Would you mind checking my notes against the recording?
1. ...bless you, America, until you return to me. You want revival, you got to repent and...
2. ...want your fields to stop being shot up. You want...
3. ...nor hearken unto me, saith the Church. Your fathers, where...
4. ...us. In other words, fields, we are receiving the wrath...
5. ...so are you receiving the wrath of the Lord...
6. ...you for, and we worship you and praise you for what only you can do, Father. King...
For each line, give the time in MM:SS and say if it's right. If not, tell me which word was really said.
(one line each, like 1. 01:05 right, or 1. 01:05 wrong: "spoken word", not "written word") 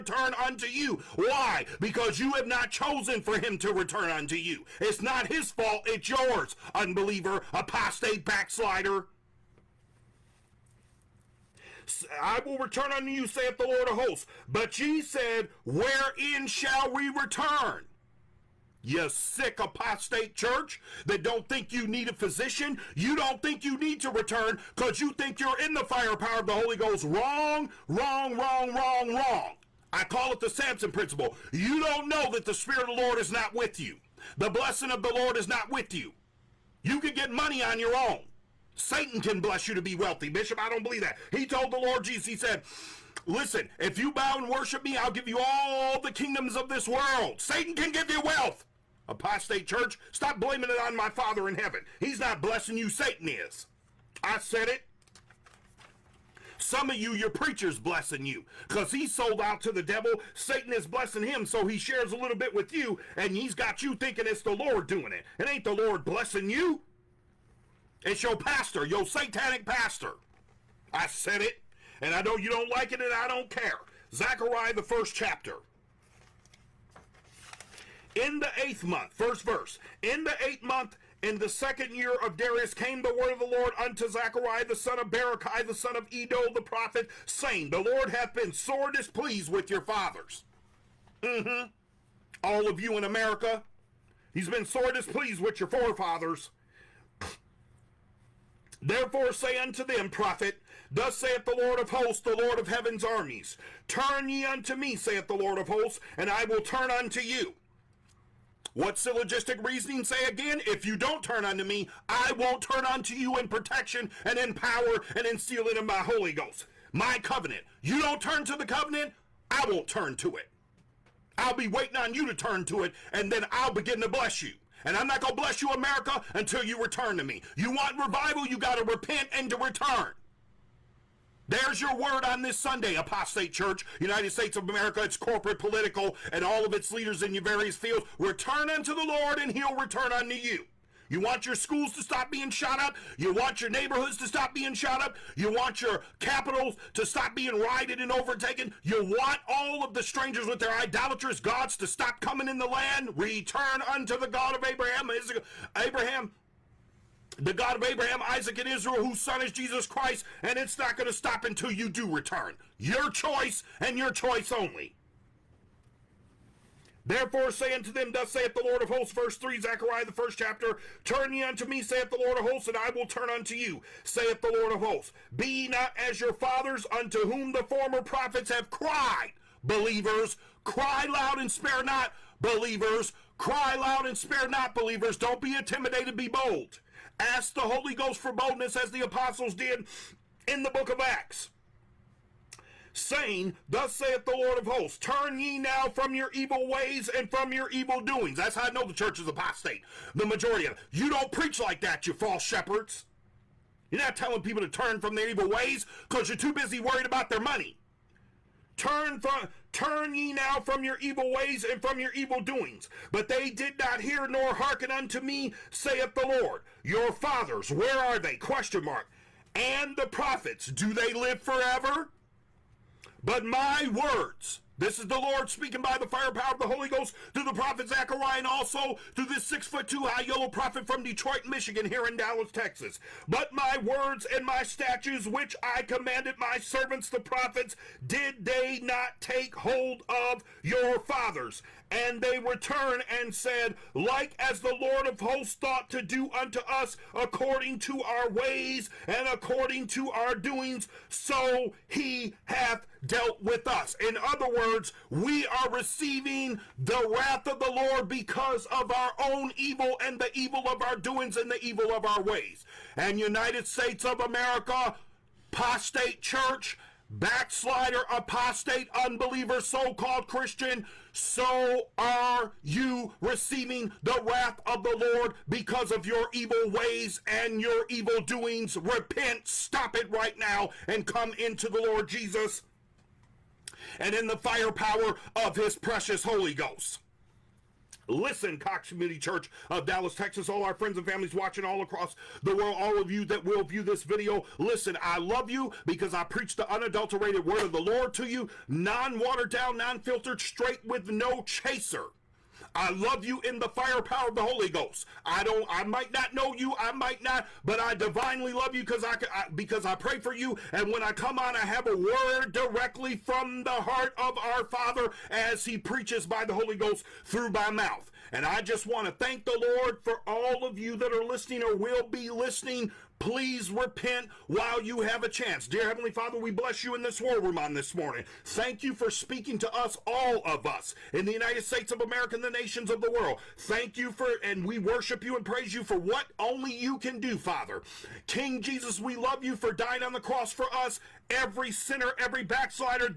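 1. 02:05 right
2. 02:23 wrong: "neighborhoods", not "fields"
3. 03:34 wrong: "Lord", not "Church"
4. 04:13 wrong: "words", not "fields"
5. 04:31 right
6. 05:33 right.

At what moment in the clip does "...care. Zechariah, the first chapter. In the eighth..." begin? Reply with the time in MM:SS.
01:13.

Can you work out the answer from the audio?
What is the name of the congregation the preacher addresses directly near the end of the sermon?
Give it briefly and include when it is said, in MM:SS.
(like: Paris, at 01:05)
Cox Community Church, at 04:48.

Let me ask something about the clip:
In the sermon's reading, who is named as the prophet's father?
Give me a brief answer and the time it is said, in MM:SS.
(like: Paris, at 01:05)
Berechiah, at 01:25.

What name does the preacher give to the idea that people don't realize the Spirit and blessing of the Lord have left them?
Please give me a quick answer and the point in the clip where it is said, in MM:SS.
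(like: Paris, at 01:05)
The Samson principle, at 00:30.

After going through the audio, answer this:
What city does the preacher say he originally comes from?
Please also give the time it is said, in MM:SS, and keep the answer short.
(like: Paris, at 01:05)
Detroit, Michigan, at 03:51.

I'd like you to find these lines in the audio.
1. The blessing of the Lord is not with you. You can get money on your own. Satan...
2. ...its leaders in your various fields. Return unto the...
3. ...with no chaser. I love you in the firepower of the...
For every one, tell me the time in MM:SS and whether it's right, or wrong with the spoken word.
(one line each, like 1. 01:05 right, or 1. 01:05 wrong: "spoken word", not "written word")
1. 00:34 right
2. 02:16 right
3. 05:00 right.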